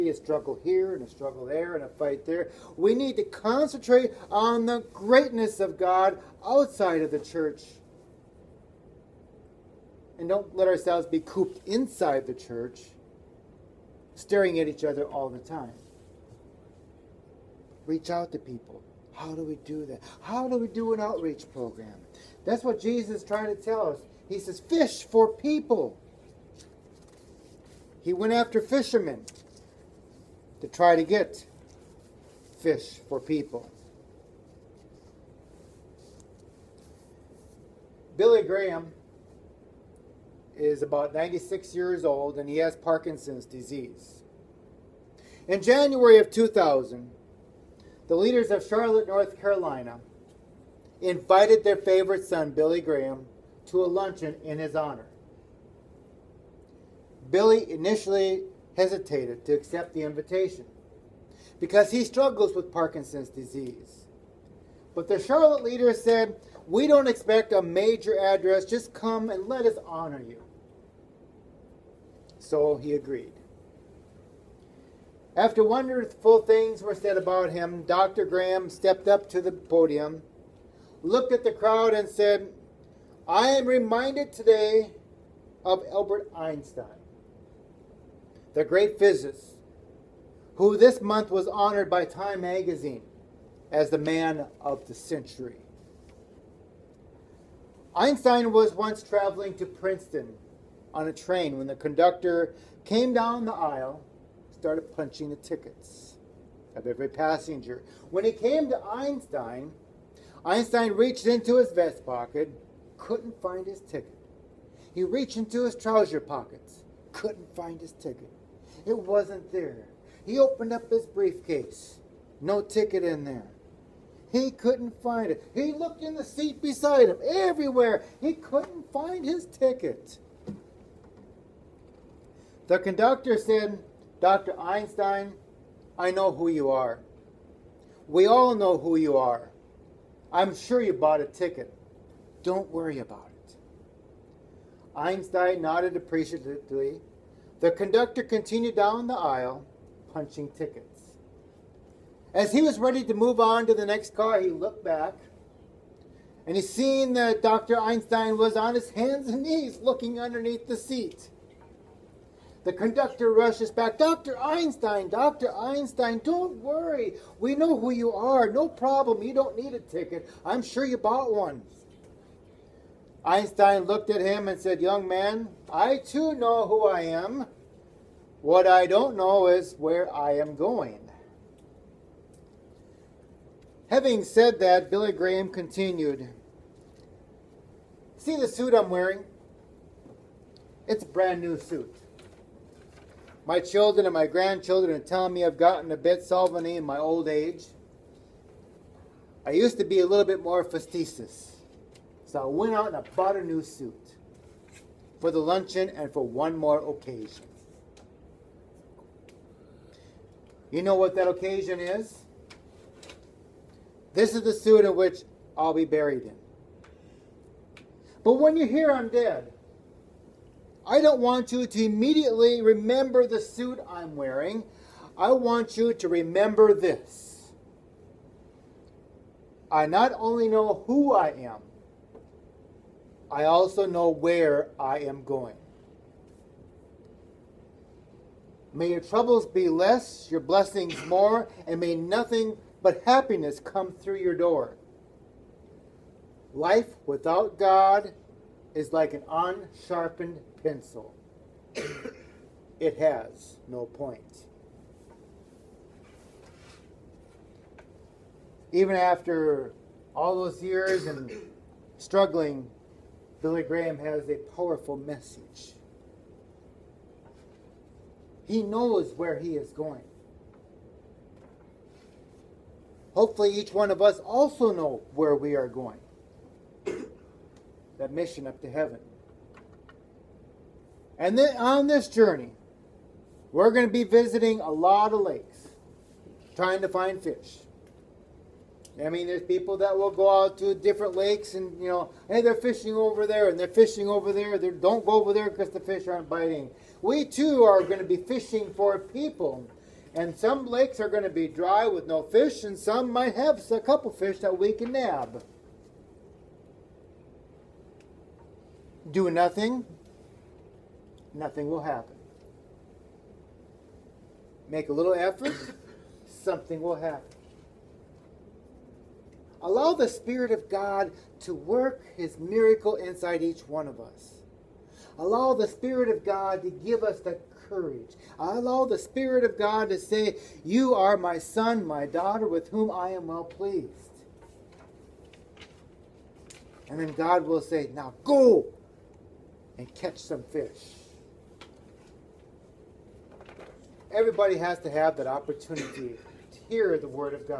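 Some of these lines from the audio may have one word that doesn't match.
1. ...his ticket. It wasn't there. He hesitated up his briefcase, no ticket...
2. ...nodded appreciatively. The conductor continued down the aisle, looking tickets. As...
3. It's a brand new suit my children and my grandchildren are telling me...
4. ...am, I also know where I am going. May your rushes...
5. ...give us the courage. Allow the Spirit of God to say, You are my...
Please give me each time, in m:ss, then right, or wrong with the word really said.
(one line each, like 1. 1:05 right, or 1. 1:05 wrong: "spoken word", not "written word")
1. 1:57 wrong: "opened", not "hesitated"
2. 2:25 wrong: "punching", not "looking"
3. 3:10 right
4. 3:51 wrong: "troubles", not "rushes"
5. 5:26 right.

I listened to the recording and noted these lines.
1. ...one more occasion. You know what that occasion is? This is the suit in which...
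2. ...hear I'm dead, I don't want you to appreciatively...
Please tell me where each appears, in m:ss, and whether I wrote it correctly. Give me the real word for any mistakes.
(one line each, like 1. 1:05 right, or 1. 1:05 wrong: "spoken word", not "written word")
1. 3:26 right
2. 3:38 wrong: "immediately", not "appreciatively".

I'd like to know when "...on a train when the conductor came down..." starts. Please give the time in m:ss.
1:40.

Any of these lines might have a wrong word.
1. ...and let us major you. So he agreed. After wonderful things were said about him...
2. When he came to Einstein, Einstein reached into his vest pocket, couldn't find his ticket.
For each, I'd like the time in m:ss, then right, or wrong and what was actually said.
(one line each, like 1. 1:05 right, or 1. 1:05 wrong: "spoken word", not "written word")
1. 1:09 wrong: "honor", not "major"
2. 1:48 right.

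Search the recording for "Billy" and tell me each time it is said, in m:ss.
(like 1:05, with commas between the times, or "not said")
0:38, 0:52, 0:57, 3:04, 4:23.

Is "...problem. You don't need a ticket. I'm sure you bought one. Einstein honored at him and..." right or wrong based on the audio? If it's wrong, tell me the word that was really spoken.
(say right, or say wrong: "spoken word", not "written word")
wrong: "looked", not "honored".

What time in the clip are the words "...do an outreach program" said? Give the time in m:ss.
0:20.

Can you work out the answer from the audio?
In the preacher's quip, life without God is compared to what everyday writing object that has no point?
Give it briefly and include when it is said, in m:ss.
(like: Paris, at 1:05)
An unsharpened pencil, at 4:09.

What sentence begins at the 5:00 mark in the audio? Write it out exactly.
And some lakes are going to be dry with no fish, and some might have a couple fish that we can nab.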